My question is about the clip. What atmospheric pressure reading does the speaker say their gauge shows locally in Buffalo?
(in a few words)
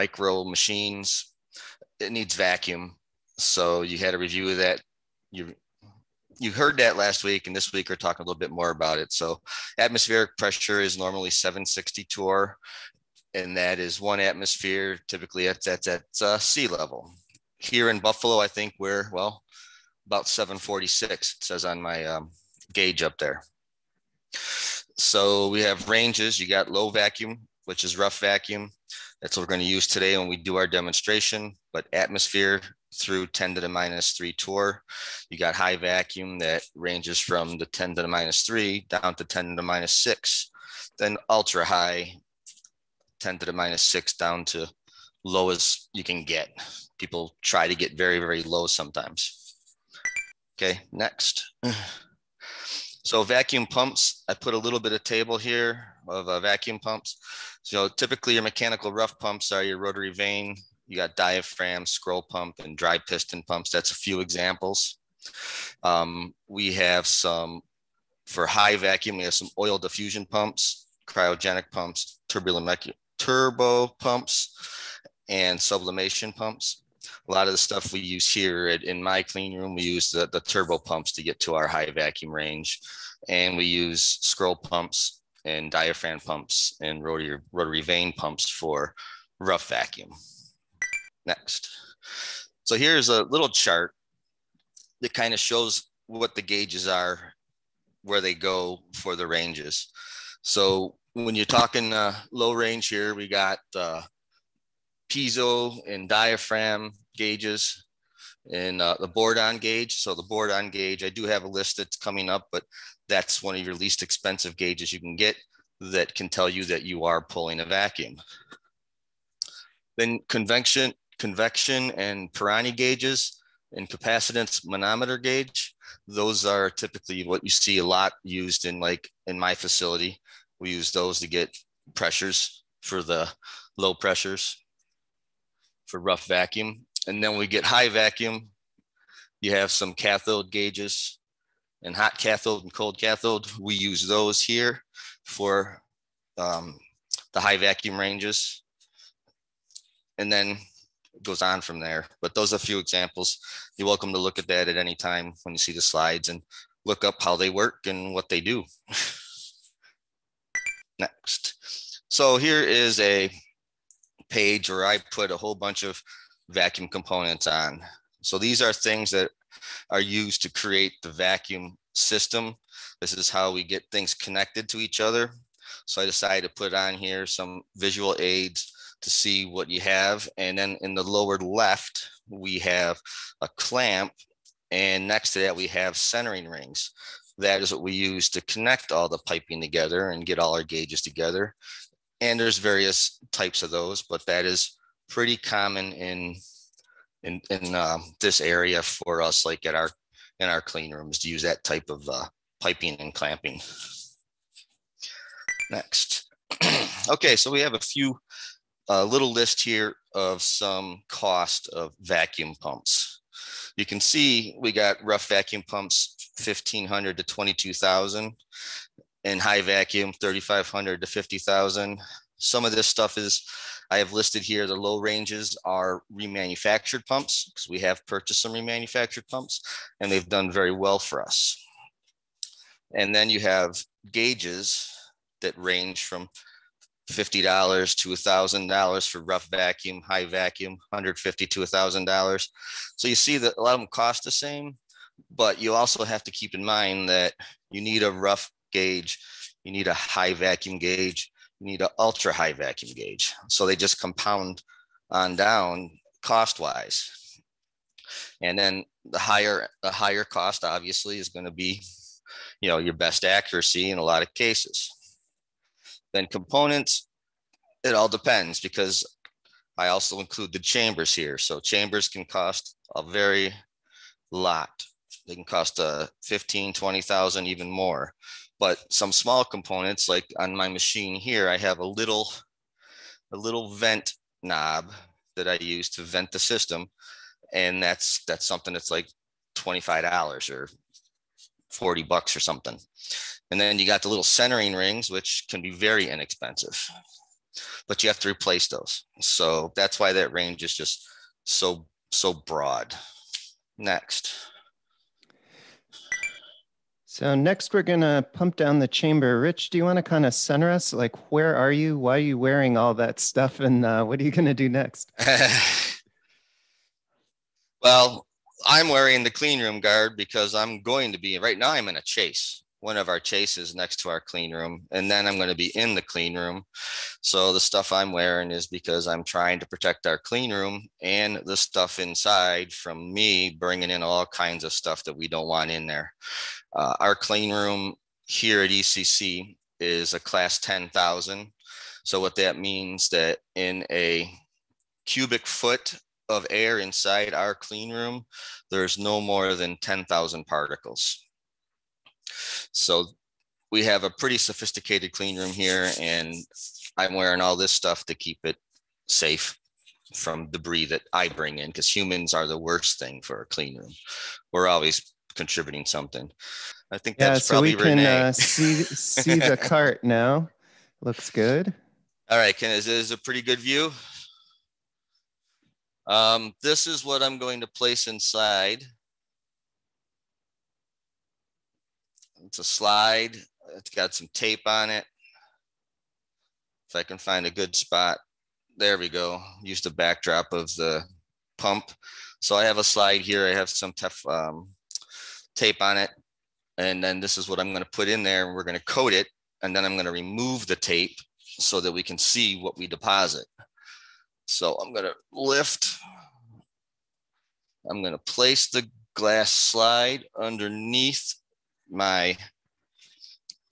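746.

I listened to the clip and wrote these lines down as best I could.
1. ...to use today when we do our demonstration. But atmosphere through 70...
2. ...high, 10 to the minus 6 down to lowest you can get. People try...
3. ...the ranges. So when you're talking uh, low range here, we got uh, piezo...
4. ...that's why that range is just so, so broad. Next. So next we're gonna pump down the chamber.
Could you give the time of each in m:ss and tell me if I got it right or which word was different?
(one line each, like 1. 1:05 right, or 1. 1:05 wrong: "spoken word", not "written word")
1. 0:29 wrong: "10", not "70"
2. 0:41 right
3. 1:39 right
4. 4:59 right.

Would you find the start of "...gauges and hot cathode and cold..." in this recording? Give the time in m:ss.
2:20.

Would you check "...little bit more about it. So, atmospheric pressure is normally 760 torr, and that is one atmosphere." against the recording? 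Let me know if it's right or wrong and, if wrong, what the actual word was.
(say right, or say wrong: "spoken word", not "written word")
right.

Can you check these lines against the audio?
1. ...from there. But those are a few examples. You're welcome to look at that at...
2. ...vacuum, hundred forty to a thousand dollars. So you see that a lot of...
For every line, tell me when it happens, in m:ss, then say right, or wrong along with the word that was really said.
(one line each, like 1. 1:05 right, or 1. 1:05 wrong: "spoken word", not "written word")
1. 2:31 right
2. 4:00 wrong: "fifty", not "forty".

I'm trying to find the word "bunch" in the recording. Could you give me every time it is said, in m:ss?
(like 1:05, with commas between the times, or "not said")
2:45.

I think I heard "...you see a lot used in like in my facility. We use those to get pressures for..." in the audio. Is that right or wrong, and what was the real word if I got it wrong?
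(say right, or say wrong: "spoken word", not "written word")
right.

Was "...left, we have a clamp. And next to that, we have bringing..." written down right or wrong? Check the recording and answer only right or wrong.
wrong.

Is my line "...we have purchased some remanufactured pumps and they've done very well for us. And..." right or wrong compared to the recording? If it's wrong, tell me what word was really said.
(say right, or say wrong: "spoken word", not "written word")
right.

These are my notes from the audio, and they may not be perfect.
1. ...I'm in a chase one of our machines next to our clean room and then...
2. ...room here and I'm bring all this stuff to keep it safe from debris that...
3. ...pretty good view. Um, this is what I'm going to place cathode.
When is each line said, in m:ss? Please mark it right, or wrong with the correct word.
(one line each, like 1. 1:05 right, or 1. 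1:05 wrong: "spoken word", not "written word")
1. 5:21 wrong: "chases", not "machines"
2. 5:55 wrong: "wearing", not "bring"
3. 6:13 wrong: "inside", not "cathode".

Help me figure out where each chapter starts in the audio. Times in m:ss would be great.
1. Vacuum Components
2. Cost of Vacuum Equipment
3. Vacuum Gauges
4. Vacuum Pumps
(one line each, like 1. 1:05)
1. 2:40
2. 3:25
3. 1:30
4. 0:49.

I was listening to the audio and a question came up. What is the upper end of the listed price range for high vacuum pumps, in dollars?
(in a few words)
50,000.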